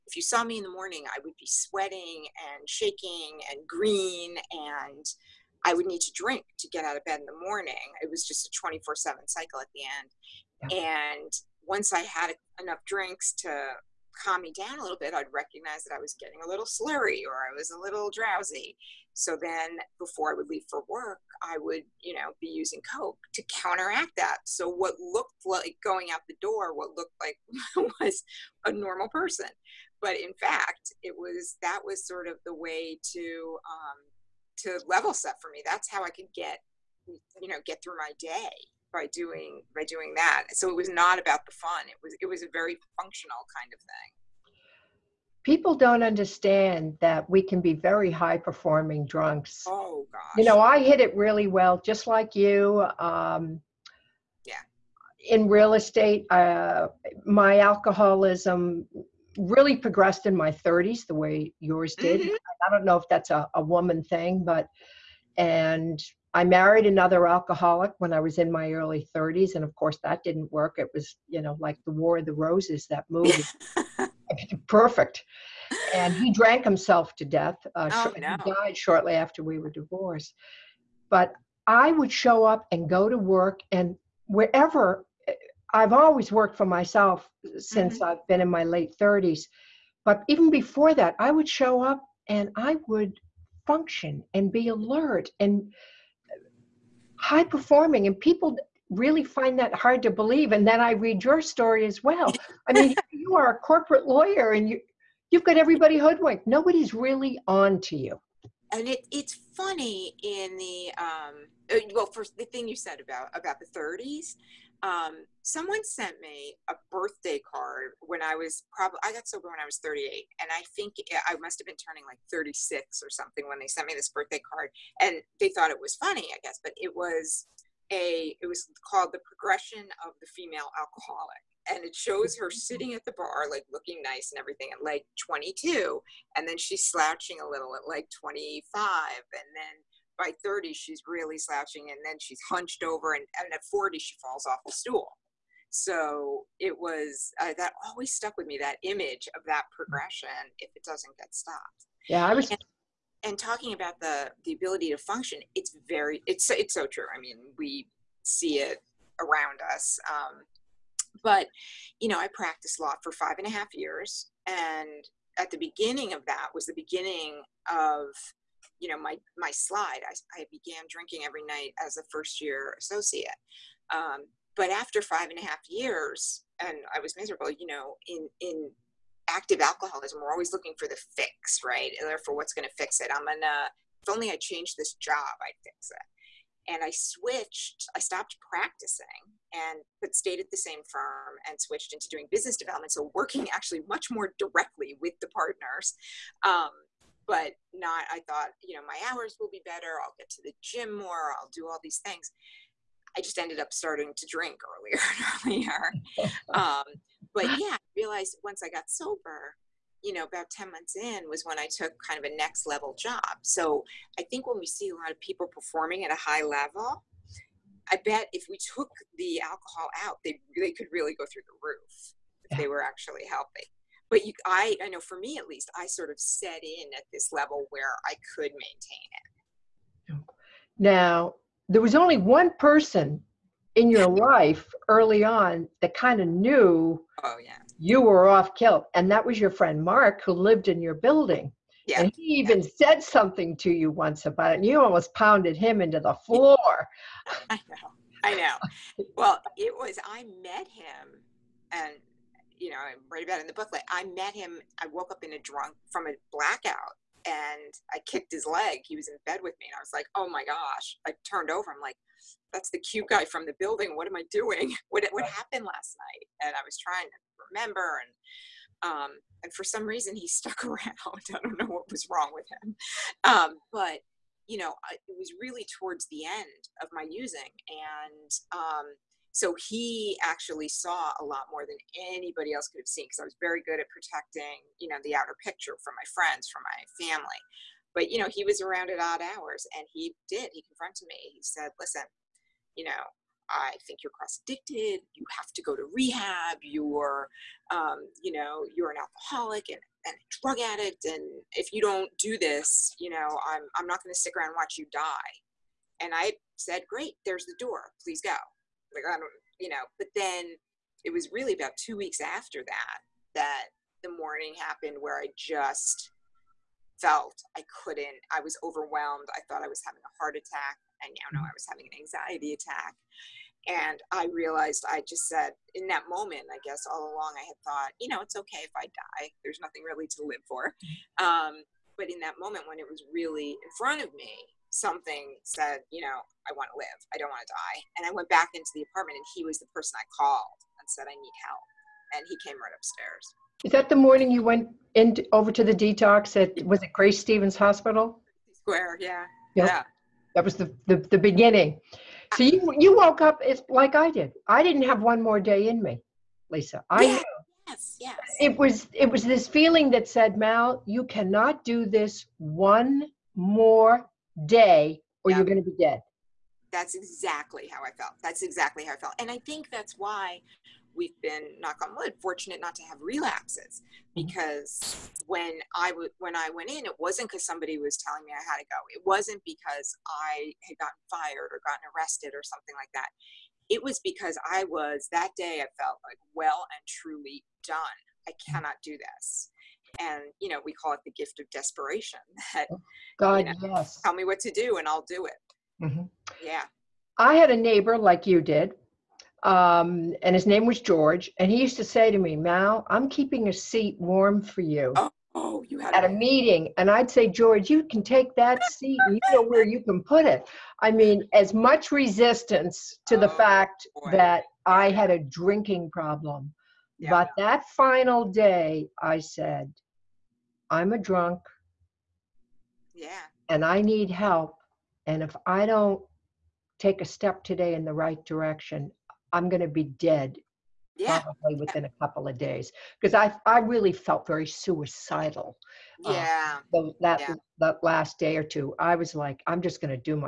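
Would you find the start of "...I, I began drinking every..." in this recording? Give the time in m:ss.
2:50.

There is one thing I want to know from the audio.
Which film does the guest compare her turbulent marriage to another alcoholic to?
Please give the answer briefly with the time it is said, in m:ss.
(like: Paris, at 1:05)
The War of the Roses, at 1:11.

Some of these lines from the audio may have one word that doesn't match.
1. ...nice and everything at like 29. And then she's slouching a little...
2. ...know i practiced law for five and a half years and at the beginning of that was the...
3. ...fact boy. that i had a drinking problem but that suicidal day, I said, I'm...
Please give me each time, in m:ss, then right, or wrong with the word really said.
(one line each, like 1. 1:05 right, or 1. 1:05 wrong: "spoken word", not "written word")
1. 2:14 wrong: "22", not "29"
2. 2:42 right
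3. 6:53 wrong: "final", not "suicidal".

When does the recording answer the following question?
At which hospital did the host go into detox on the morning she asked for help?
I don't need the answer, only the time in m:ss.
5:46.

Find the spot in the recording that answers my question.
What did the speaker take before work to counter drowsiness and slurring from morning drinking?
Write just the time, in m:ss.
0:22.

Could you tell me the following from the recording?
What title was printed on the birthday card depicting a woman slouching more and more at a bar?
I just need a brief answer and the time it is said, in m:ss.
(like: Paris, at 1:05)
The Progression of the Female Alcoholic, at 2:09.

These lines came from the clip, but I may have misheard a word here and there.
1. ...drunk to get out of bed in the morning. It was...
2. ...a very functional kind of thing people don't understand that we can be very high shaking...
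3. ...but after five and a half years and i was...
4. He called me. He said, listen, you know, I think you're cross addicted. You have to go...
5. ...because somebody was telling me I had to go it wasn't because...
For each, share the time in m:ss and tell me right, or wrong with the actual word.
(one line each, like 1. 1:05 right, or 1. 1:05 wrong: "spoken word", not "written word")
1. 0:06 wrong: "drink", not "drunk"
2. 0:42 wrong: "performing", not "shaking"
3. 2:54 right
4. 4:50 wrong: "confronted", not "called"
5. 6:17 right.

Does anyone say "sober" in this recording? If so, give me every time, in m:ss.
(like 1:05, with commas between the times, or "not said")
1:59, 3:28.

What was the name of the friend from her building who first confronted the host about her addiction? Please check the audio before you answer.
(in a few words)
Mark.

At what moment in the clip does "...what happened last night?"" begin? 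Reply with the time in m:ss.
4:25.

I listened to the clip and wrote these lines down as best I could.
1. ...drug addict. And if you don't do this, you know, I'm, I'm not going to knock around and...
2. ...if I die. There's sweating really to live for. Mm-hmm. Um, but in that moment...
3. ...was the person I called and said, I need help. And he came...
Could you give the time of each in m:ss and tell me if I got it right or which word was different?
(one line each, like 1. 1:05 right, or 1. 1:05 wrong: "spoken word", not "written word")
1. 5:00 wrong: "stick", not "knock"
2. 5:28 wrong: "nothing", not "sweating"
3. 5:39 right.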